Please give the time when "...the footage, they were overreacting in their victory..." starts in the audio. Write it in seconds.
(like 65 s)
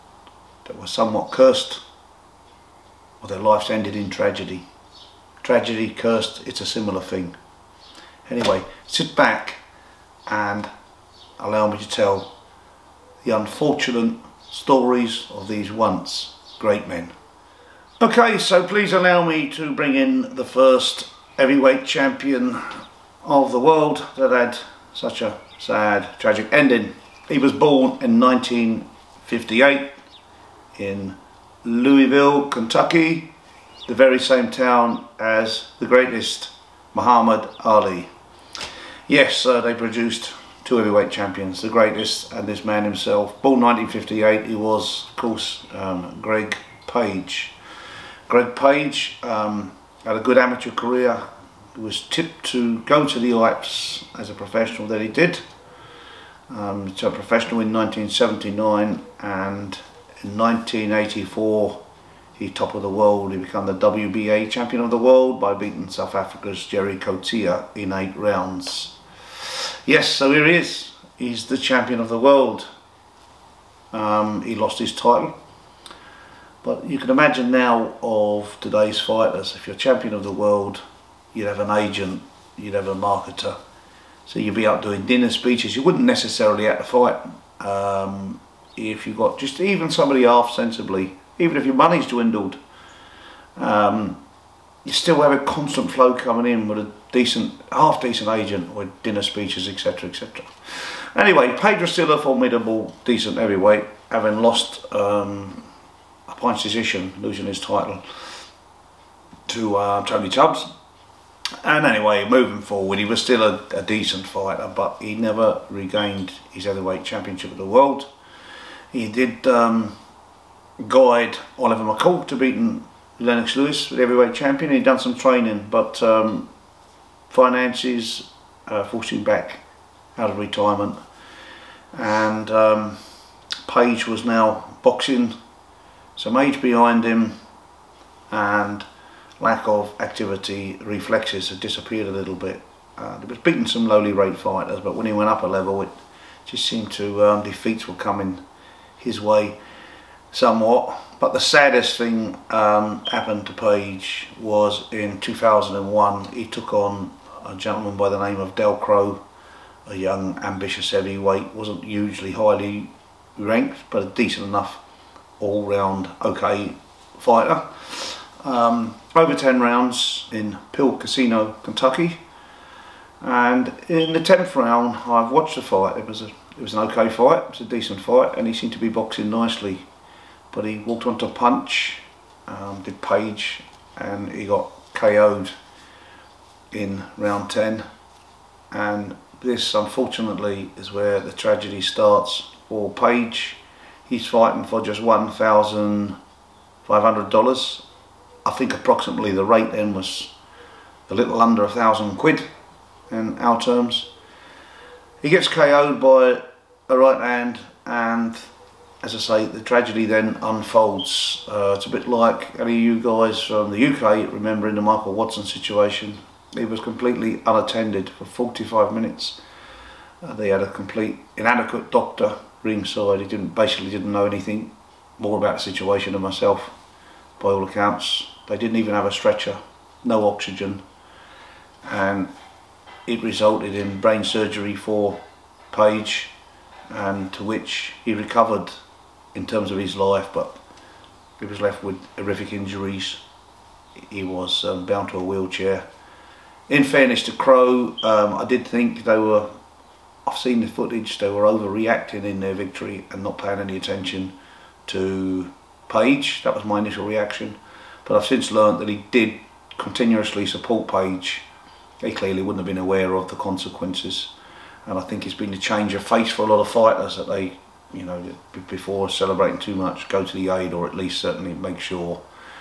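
250 s.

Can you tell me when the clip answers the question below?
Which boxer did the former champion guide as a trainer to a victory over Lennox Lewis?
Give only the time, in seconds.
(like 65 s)
121 s.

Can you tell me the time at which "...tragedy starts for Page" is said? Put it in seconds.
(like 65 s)
191 s.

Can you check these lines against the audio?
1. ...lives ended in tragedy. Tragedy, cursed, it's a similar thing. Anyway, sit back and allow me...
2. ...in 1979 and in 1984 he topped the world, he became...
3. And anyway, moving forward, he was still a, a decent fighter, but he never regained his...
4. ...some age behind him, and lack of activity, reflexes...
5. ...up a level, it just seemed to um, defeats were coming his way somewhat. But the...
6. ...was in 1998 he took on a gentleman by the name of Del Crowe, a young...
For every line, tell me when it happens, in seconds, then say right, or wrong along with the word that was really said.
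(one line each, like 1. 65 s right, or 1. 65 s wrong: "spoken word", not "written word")
1. 3 s right
2. 57 s right
3. 111 s right
4. 136 s right
5. 145 s right
6. 154 s wrong: "2001", not "1998".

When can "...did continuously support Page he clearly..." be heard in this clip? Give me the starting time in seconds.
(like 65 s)
259 s.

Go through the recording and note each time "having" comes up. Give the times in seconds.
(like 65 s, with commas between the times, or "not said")
104 s.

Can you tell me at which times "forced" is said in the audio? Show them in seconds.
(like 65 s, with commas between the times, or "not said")
128 s.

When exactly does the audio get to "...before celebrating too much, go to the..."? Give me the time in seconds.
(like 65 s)
268 s.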